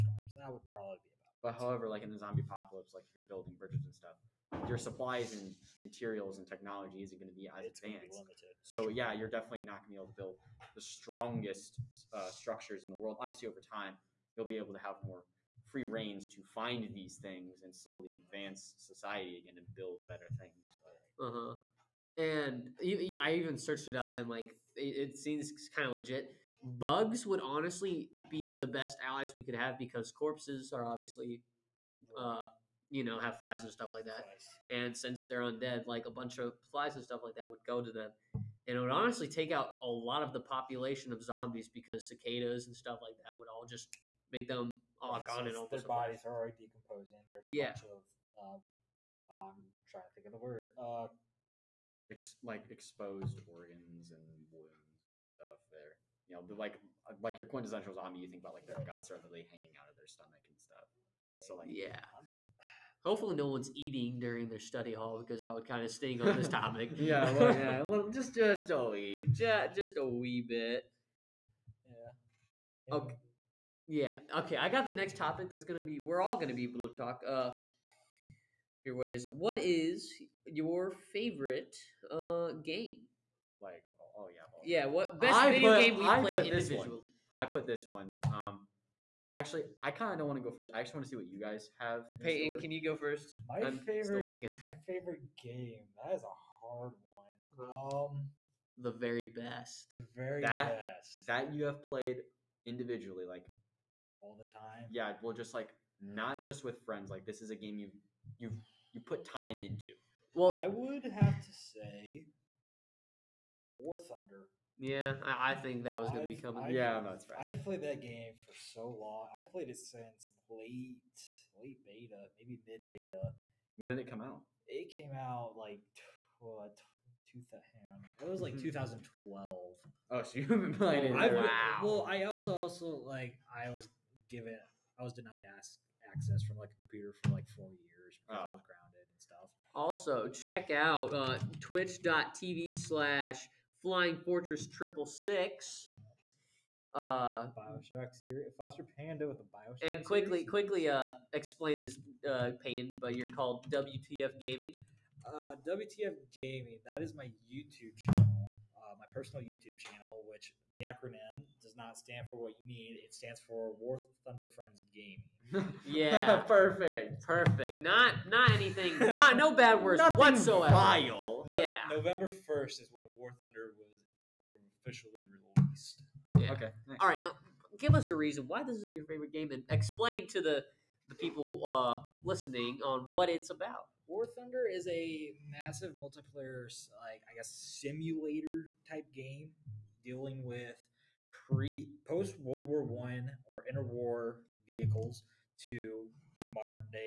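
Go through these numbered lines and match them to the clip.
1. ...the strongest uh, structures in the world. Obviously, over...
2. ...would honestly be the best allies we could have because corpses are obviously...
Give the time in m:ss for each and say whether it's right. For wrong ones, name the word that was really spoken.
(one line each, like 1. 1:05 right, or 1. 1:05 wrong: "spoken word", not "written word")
1. 0:10 right
2. 0:27 right.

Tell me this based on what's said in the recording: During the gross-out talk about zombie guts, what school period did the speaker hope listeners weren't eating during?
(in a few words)
Study hall.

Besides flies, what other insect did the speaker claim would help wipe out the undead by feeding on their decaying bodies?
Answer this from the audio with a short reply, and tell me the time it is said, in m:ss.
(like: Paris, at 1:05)
Cicadas, at 0:42.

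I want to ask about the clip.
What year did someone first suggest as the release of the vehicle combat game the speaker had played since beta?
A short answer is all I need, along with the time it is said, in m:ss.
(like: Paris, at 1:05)
2012, at 2:08.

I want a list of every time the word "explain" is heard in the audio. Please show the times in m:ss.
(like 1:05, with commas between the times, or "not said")
2:31, 2:59.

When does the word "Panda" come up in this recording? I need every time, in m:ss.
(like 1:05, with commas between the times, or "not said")
2:28.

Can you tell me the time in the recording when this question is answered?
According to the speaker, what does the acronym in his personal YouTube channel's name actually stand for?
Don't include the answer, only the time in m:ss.
2:43.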